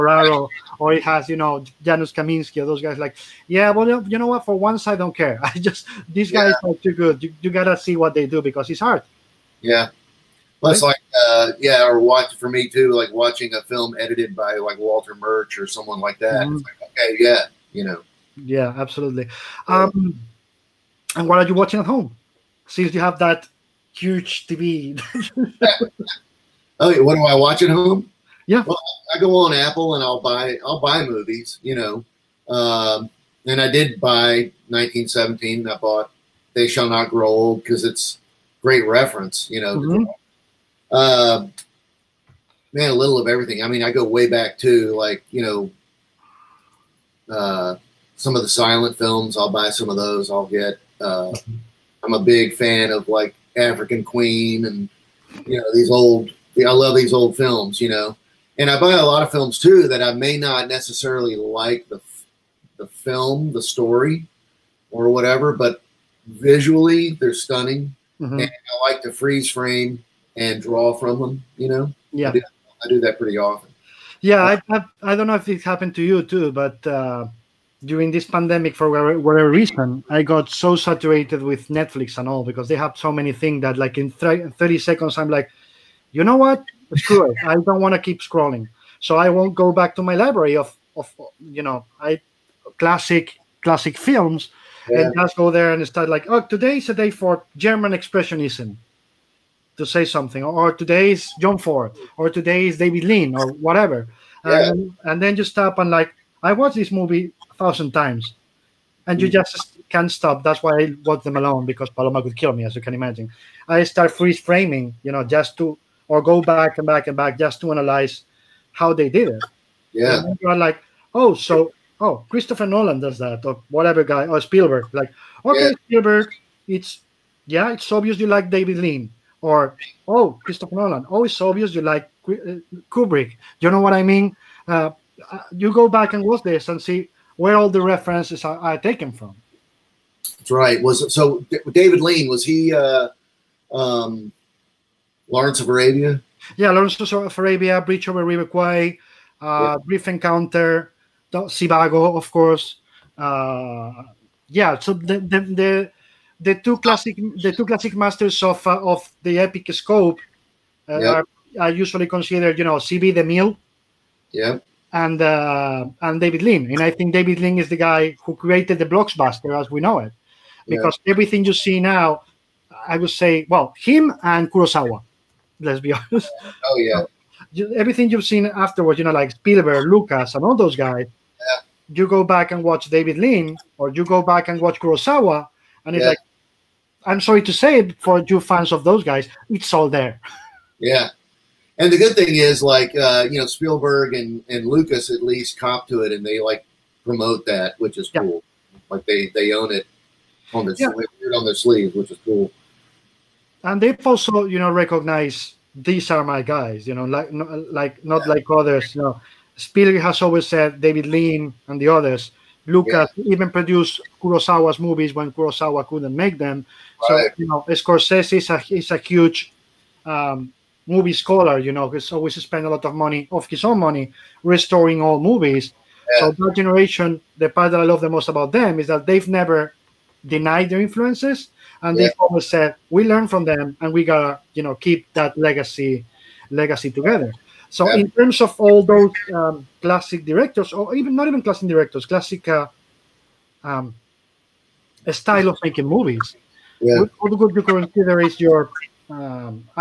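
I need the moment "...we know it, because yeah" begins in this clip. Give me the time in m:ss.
2:49.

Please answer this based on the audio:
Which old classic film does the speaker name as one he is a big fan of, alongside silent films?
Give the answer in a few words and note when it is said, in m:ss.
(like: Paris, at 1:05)
African Queen, at 0:53.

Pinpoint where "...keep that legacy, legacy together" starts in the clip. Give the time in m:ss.
3:54.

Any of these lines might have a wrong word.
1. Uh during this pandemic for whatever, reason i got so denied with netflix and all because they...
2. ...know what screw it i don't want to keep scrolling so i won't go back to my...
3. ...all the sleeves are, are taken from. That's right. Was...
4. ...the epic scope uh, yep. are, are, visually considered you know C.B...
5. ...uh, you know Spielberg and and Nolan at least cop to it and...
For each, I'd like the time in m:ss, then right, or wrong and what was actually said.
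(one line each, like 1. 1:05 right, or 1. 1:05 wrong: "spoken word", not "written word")
1. 1:16 wrong: "saturated", not "denied"
2. 1:26 right
3. 2:17 wrong: "references", not "sleeves"
4. 2:39 wrong: "usually", not "visually"
5. 3:12 wrong: "Lucas", not "Nolan".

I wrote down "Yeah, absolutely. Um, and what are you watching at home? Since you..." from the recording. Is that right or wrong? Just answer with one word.
right.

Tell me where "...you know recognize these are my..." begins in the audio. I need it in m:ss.
3:24.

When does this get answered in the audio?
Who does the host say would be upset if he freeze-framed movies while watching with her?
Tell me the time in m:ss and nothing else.
1:51.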